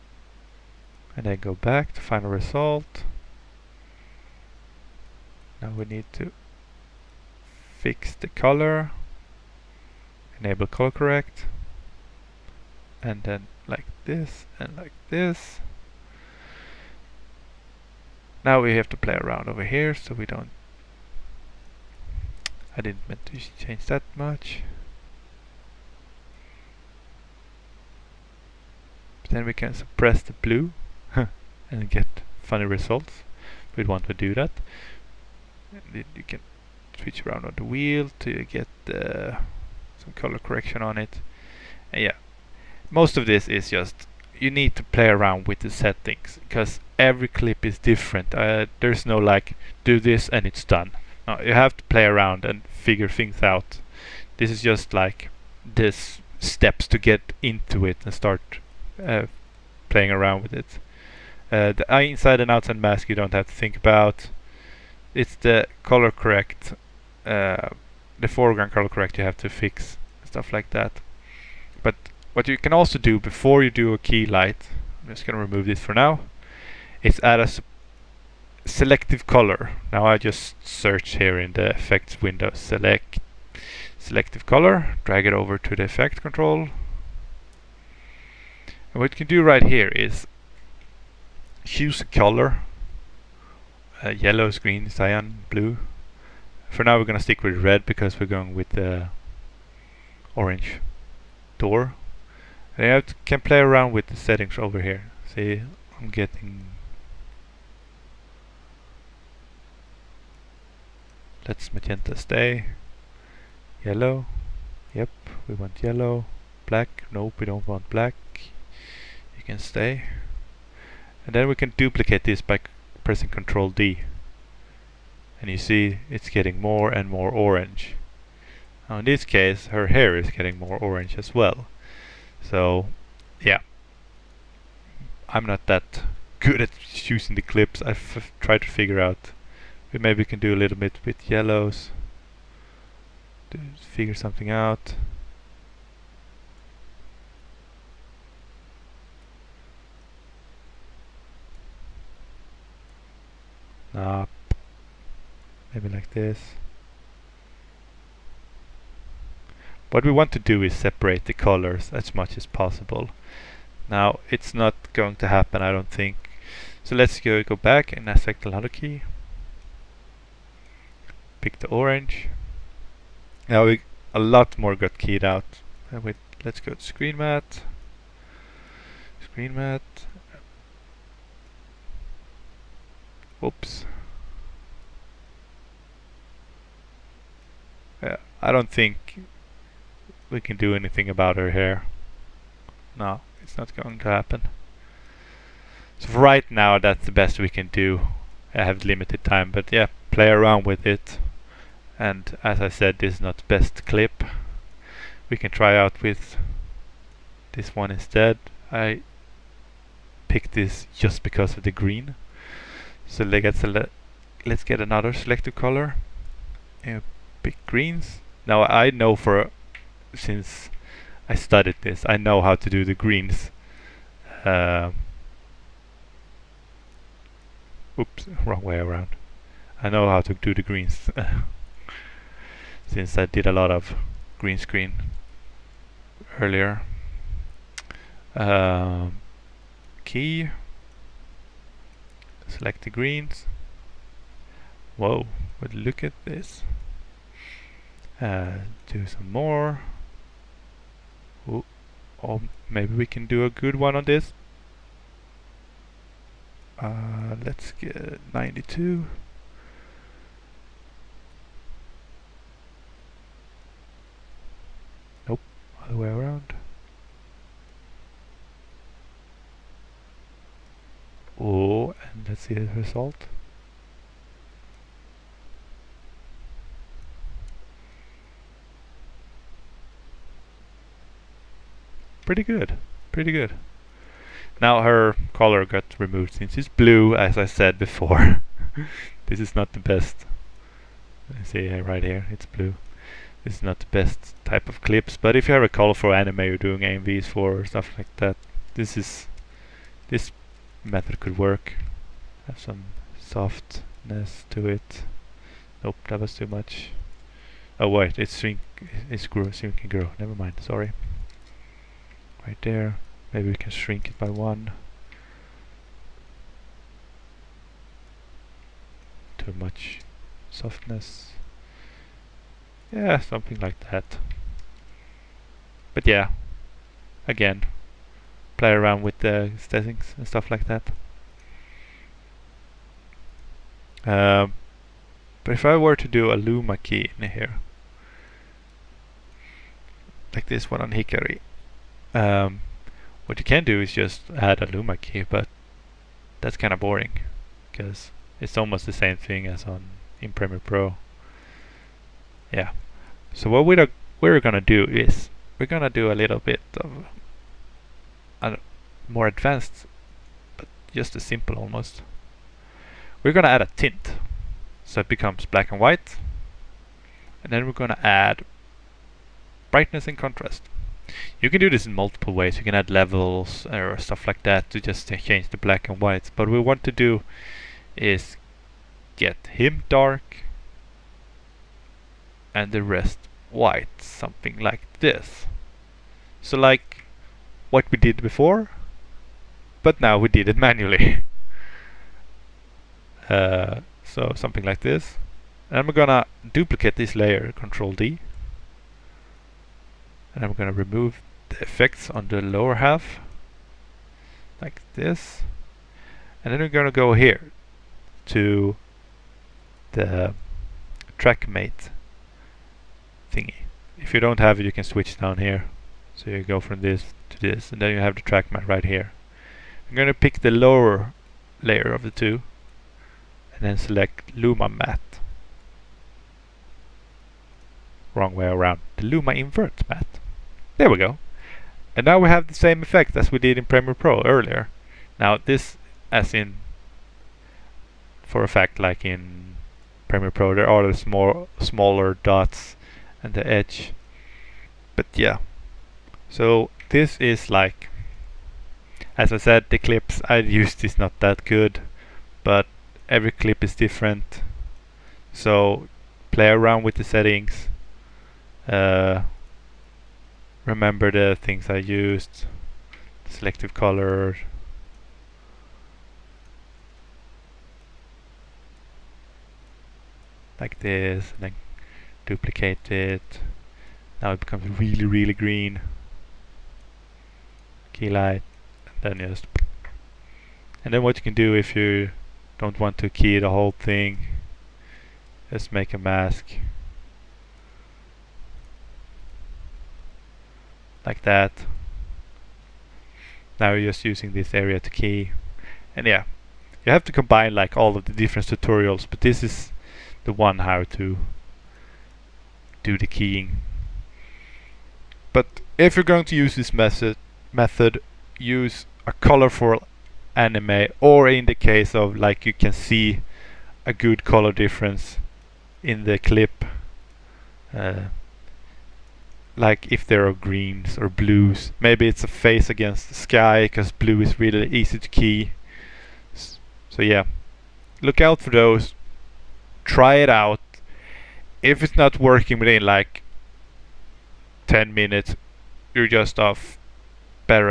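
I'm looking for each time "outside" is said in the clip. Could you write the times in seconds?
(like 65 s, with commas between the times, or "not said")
62 s.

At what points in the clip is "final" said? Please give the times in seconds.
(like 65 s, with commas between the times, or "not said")
2 s.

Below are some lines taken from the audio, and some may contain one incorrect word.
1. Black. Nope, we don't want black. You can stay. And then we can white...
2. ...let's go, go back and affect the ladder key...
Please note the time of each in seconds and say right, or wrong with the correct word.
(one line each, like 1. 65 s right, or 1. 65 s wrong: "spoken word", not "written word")
1. 116 s wrong: "duplicate", not "white"
2. 166 s right.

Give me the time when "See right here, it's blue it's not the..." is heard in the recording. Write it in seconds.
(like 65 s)
291 s.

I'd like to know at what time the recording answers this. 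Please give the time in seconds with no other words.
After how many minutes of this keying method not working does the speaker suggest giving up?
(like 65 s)
534 s.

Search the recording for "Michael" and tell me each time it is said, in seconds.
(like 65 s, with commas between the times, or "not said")
not said.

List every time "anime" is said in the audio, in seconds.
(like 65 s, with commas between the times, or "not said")
296 s, 510 s.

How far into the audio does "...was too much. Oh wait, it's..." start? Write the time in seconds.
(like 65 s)
306 s.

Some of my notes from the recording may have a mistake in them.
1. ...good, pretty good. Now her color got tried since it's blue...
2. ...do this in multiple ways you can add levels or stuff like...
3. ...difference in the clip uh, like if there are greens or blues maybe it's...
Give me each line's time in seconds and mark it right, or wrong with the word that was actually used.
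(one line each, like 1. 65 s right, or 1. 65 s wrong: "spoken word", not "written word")
1. 282 s wrong: "removed", not "tried"
2. 371 s right
3. 514 s right.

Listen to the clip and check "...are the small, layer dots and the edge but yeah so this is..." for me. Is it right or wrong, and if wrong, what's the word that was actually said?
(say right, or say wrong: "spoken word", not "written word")
wrong: "smaller", not "layer".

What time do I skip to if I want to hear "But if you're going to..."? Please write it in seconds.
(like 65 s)
505 s.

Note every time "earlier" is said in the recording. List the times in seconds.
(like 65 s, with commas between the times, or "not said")
236 s, 434 s.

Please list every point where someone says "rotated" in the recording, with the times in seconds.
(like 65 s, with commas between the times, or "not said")
not said.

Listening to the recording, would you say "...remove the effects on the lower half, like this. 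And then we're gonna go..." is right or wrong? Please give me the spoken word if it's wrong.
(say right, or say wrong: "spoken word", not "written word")
right.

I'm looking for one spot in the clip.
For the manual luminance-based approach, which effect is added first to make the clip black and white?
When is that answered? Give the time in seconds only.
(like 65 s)
363 s.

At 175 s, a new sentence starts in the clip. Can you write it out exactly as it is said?
Uh, wait, let's go to screen matte.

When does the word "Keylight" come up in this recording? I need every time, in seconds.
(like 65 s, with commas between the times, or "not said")
73 s, 477 s.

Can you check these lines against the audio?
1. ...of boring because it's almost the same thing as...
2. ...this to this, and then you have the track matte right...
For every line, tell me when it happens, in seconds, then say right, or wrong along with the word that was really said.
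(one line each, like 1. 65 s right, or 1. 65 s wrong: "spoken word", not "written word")
1. 346 s right
2. 416 s right.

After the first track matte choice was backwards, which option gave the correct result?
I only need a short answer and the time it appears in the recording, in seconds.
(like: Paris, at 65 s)
Luma invert matte, at 429 s.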